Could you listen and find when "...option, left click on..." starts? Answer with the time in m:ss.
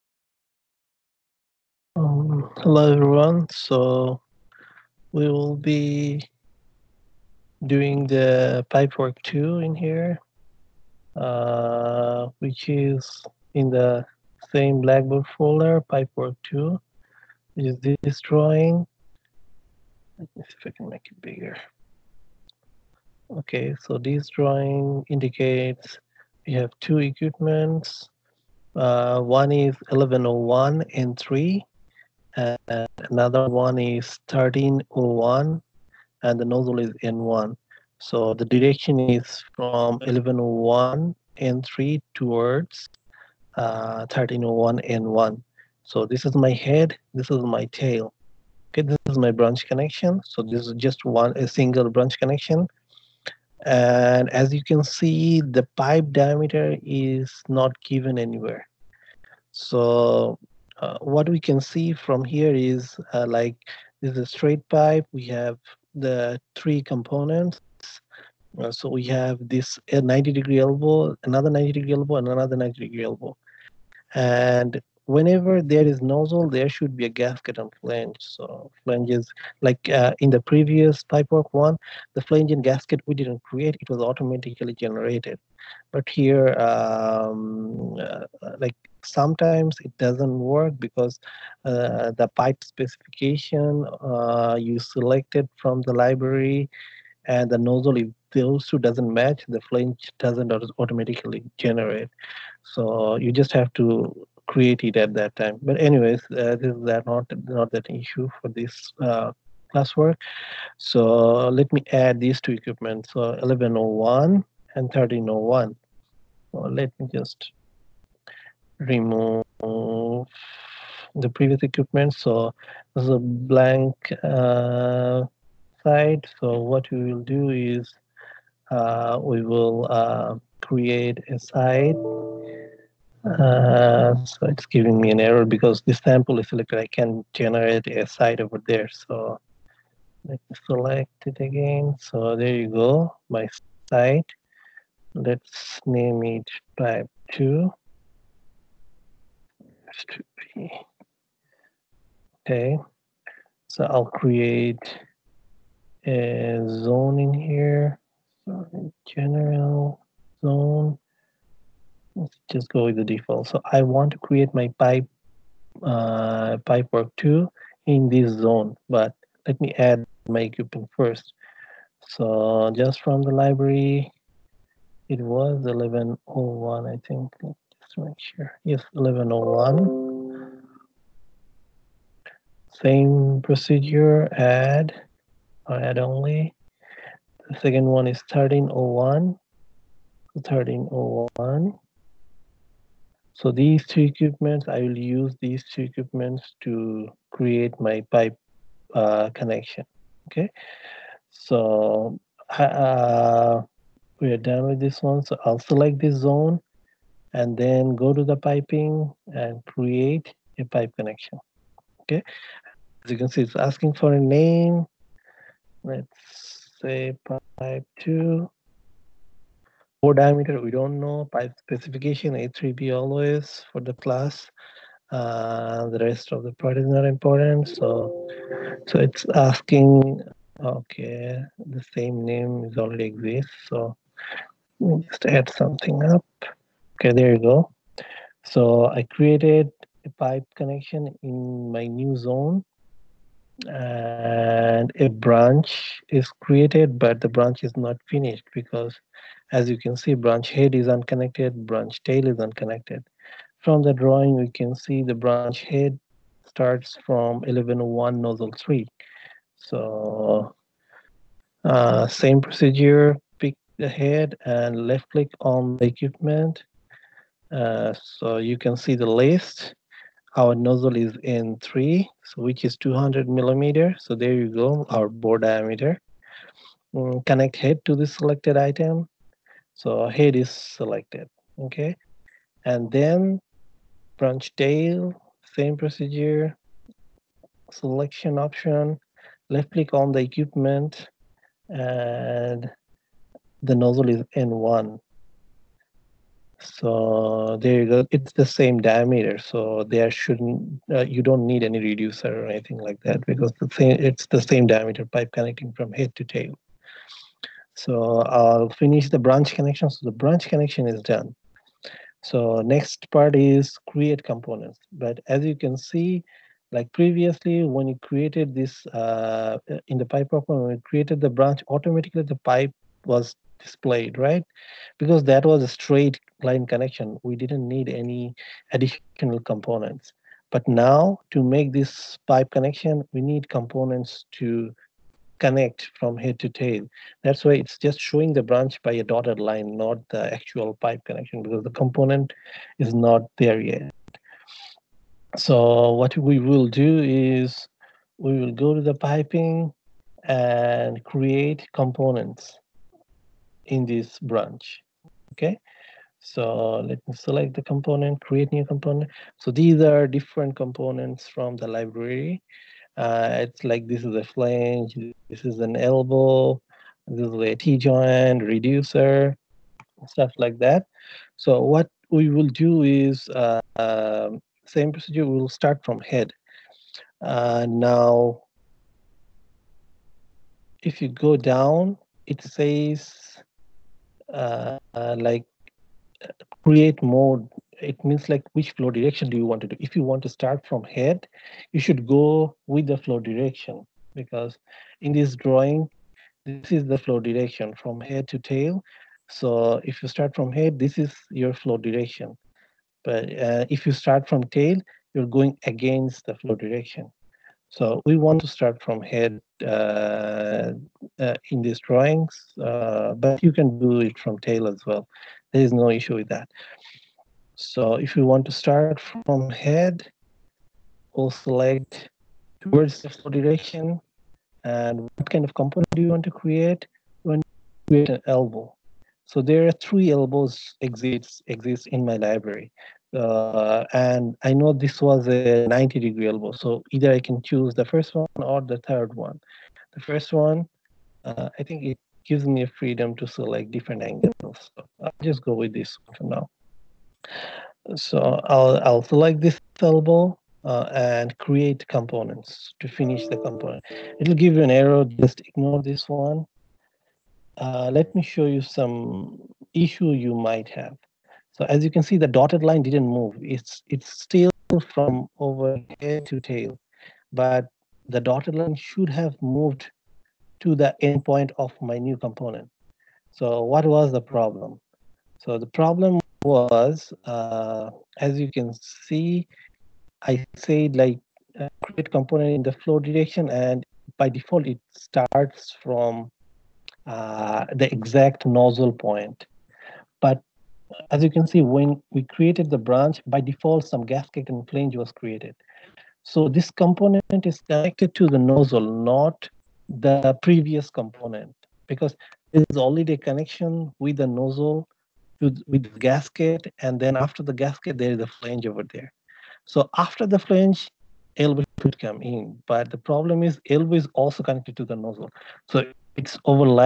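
4:48.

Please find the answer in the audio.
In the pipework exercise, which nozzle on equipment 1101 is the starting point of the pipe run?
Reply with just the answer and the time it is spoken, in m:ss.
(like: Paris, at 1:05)
N3, at 0:39.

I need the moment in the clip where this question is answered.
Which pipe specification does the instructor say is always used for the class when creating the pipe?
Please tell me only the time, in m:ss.
3:42.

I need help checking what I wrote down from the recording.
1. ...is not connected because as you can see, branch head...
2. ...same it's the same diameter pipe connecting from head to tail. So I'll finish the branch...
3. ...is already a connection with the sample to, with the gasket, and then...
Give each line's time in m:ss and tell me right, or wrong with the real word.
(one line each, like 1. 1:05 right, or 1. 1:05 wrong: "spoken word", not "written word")
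1. 4:07 wrong: "finished", not "connected"
2. 5:03 right
3. 8:22 wrong: "nozzle", not "sample".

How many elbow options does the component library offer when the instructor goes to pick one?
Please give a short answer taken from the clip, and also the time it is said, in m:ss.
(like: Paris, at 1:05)
3, at 7:09.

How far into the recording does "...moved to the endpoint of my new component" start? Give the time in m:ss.
7:49.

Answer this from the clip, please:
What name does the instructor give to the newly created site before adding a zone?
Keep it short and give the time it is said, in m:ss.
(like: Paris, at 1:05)
type 2, at 2:26.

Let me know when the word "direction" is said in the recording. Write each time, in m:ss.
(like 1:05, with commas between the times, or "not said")
0:38, 6:28, 6:33, 6:37, 6:41, 6:46, 7:03, 8:02.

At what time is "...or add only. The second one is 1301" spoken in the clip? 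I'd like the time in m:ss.
3:05.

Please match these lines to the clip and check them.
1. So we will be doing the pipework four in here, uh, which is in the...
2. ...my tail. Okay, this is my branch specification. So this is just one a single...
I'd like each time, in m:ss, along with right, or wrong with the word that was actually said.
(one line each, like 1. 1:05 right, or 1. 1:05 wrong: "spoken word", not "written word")
1. 0:03 wrong: "two", not "four"
2. 0:47 wrong: "connection", not "specification".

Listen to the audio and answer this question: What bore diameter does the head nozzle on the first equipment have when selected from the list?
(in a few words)
200 millimeter.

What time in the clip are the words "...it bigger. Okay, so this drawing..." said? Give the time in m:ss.
0:21.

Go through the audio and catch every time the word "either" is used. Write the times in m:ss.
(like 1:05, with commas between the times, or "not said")
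7:16.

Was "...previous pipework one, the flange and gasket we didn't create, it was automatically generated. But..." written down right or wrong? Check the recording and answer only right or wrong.
right.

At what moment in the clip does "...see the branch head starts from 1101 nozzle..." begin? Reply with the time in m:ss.
4:14.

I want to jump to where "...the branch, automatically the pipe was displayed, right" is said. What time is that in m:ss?
5:21.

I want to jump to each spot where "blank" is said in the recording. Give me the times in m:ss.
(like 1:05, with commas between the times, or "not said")
2:03.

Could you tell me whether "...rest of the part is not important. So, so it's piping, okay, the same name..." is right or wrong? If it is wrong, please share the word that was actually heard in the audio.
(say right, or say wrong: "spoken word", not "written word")
wrong: "asking", not "piping".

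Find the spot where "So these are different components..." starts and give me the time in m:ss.
5:59.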